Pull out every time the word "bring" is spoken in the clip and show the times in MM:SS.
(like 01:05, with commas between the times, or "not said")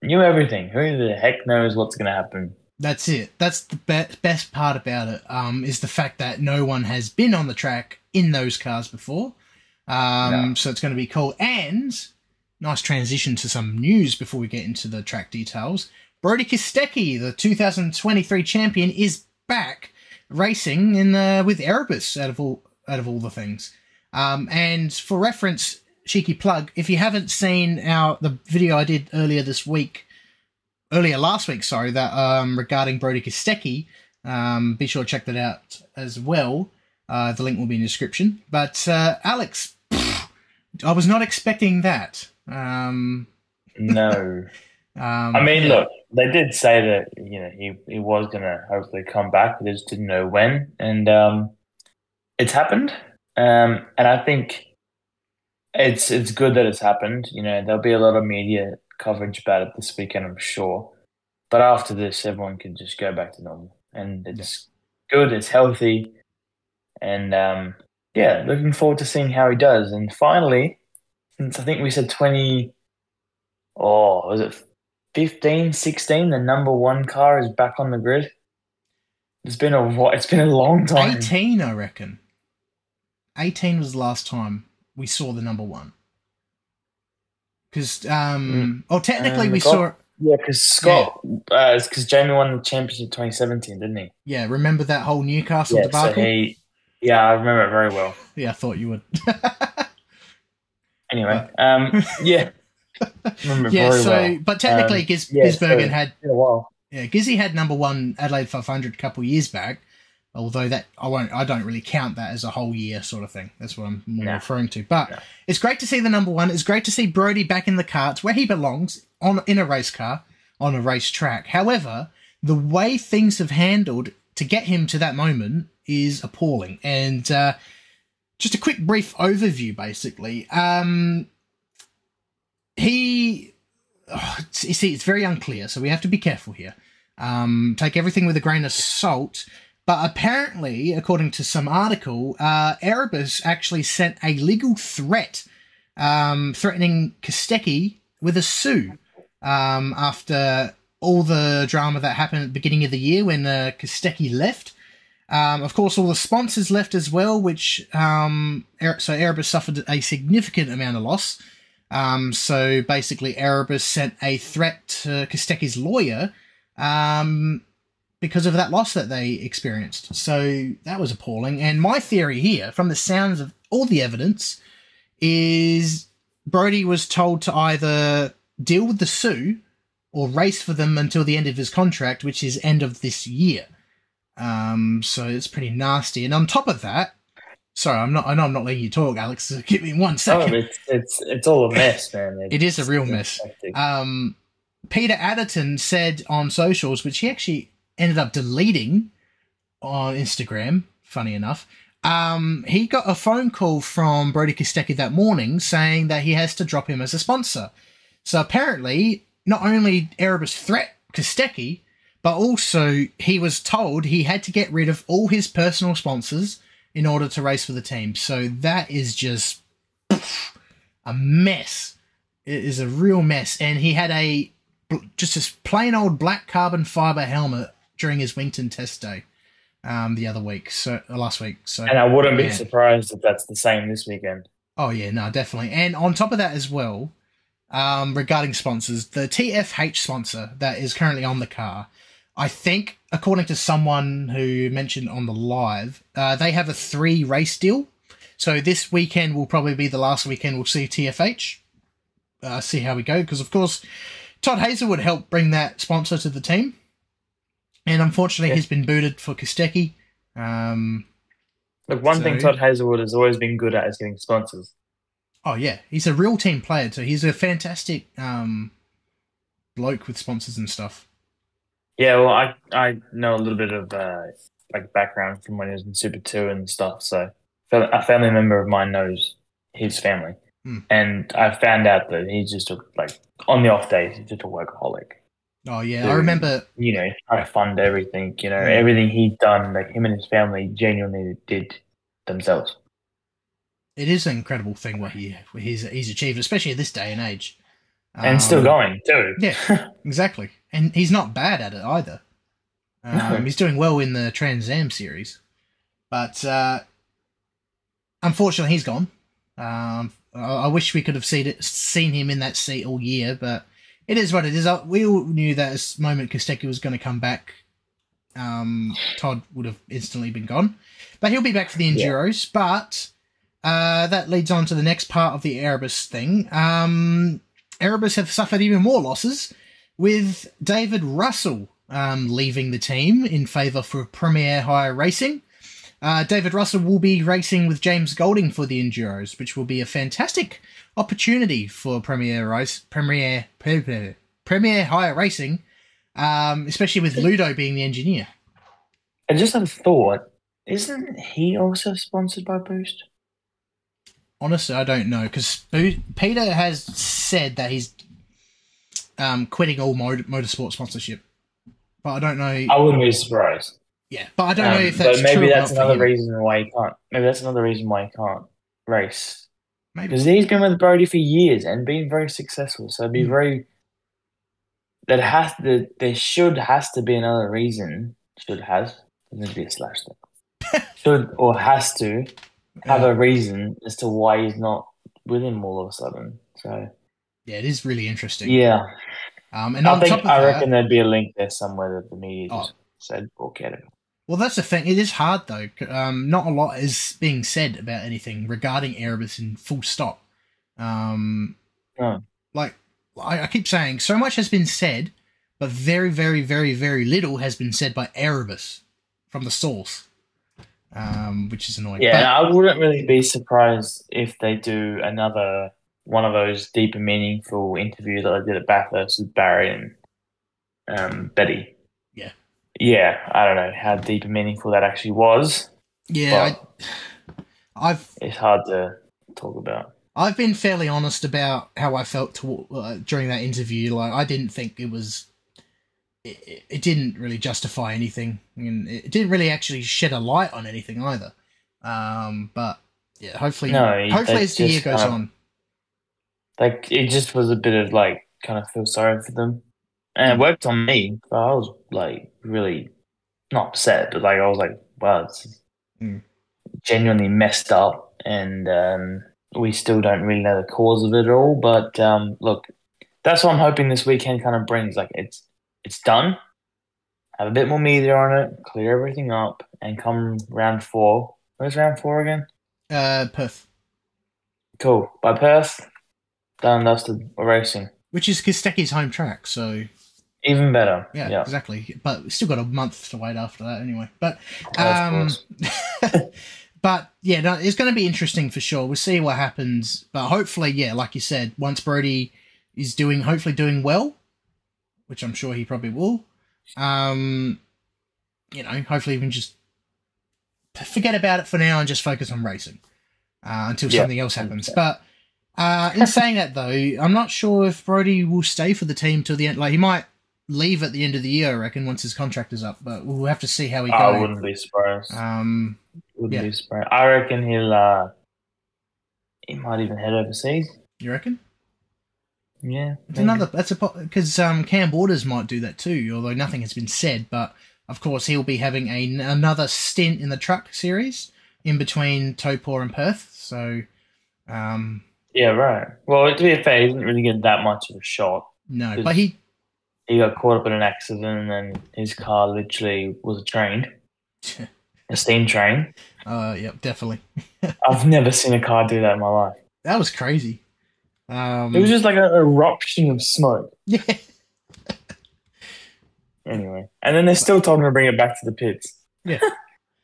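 04:15, 07:44, 09:17.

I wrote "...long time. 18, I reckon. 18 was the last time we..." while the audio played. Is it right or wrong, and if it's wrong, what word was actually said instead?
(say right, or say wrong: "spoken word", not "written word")
right.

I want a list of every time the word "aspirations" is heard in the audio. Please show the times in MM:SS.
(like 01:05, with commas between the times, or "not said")
not said.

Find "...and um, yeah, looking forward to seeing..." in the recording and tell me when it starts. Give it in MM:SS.
01:06.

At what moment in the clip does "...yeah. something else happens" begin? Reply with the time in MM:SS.
08:23.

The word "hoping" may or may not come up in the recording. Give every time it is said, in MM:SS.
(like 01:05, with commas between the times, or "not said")
07:43.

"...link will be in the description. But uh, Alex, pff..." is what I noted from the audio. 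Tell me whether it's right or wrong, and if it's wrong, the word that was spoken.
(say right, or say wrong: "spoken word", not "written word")
right.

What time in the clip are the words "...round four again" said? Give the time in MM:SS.
07:51.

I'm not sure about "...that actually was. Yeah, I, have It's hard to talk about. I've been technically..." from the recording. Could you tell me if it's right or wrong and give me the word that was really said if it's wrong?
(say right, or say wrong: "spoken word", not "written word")
wrong: "fairly", not "technically".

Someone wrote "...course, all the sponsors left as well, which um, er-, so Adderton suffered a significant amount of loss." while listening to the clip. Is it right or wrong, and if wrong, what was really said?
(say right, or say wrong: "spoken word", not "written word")
wrong: "Erebus", not "Adderton".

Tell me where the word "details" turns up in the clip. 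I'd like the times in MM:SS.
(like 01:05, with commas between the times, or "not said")
00:15.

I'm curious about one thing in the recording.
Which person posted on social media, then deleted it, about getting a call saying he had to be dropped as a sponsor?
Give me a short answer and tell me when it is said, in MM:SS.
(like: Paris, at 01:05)
Peter Adderton, at 03:14.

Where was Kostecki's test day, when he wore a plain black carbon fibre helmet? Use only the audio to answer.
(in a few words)
Winton.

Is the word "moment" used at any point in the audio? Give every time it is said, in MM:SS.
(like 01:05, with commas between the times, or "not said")
02:05, 05:15.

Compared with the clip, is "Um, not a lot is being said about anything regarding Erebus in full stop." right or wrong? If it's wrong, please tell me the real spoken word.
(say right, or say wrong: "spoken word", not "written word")
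right.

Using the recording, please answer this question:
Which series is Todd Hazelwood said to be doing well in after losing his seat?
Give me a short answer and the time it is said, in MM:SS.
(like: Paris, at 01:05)
Trans Am series, at 05:04.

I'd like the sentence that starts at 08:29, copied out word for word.
Like he might leave at the end of the year, I reckon, once his contract is up.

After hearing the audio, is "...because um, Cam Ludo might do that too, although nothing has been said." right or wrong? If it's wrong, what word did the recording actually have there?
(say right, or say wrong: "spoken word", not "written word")
wrong: "Waters", not "Ludo".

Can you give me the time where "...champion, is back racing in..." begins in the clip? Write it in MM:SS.
00:18.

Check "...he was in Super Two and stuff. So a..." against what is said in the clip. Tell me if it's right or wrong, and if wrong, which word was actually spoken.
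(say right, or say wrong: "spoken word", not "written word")
right.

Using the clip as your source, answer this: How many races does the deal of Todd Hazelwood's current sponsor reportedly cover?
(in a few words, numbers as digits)
3.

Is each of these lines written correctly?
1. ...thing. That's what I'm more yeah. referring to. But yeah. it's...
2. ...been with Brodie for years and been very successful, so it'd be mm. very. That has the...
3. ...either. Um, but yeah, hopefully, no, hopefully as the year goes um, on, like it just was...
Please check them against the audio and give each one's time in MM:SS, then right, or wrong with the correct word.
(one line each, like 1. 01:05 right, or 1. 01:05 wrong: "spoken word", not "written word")
1. 01:53 right
2. 06:10 right
3. 07:21 right.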